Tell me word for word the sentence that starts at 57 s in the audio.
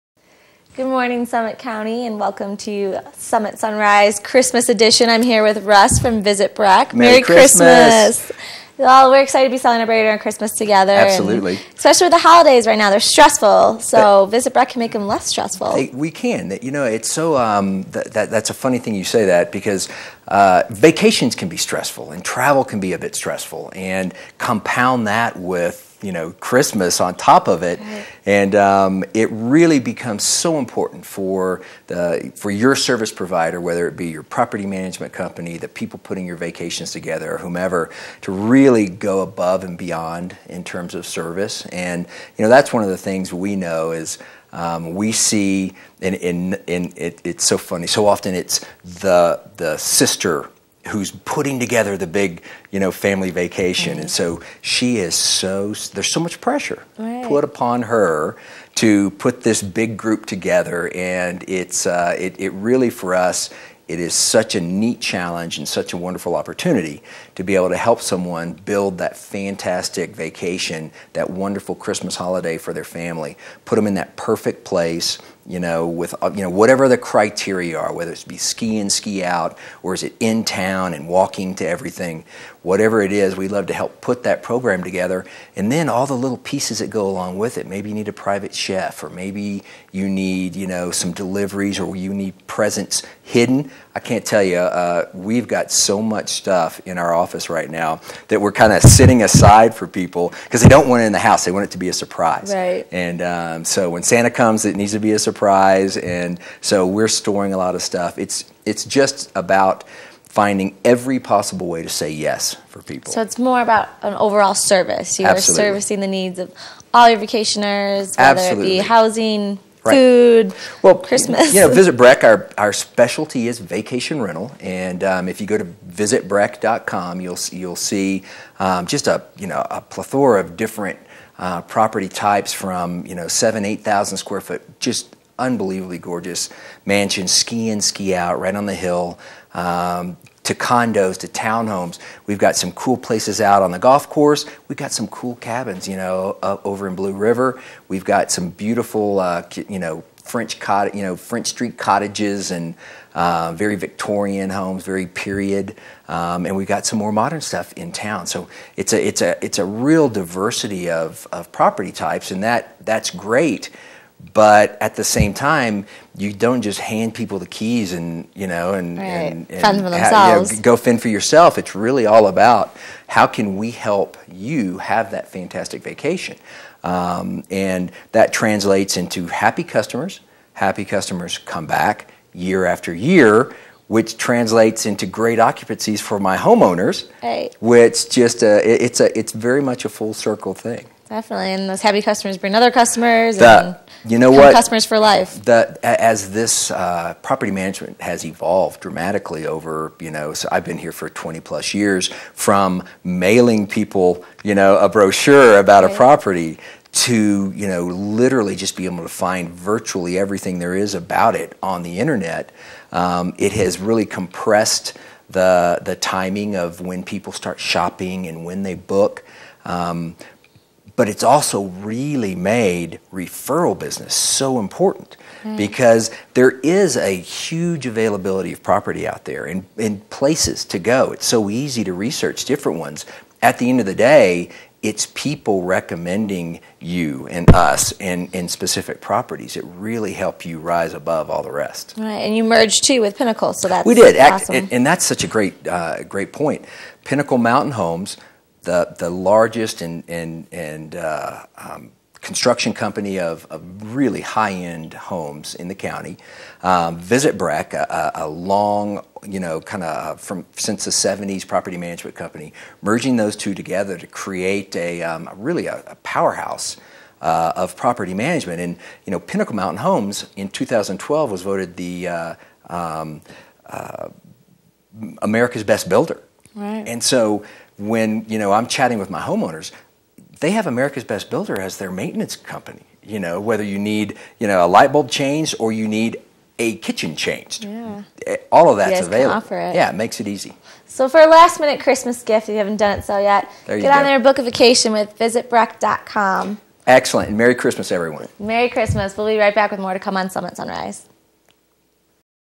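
put upon her to put this big group together, and it's uh, it, it really for us.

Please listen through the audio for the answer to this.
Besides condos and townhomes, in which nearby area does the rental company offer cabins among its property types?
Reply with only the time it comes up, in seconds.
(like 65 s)
146 s.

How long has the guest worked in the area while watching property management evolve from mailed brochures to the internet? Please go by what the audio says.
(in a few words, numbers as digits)
20 plus years.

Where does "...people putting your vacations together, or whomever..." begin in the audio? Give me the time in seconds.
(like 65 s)
35 s.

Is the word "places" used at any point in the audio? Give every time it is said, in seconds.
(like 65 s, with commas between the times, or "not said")
74 s, 142 s, 230 s.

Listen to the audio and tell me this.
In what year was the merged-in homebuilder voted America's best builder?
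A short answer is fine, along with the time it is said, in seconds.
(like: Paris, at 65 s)
2012, at 270 s.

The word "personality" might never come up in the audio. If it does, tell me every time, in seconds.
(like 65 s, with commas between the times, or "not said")
not said.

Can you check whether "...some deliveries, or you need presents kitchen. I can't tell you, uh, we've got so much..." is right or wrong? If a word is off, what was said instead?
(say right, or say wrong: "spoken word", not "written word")
wrong: "hidden", not "kitchen".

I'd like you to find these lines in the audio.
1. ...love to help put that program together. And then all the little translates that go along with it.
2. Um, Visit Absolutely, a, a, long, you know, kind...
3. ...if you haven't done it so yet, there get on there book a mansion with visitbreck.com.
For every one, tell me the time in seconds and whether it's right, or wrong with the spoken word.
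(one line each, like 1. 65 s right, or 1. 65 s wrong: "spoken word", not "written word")
1. 83 s wrong: "pieces", not "translates"
2. 256 s wrong: "Breck", not "Absolutely"
3. 292 s wrong: "vacation", not "mansion".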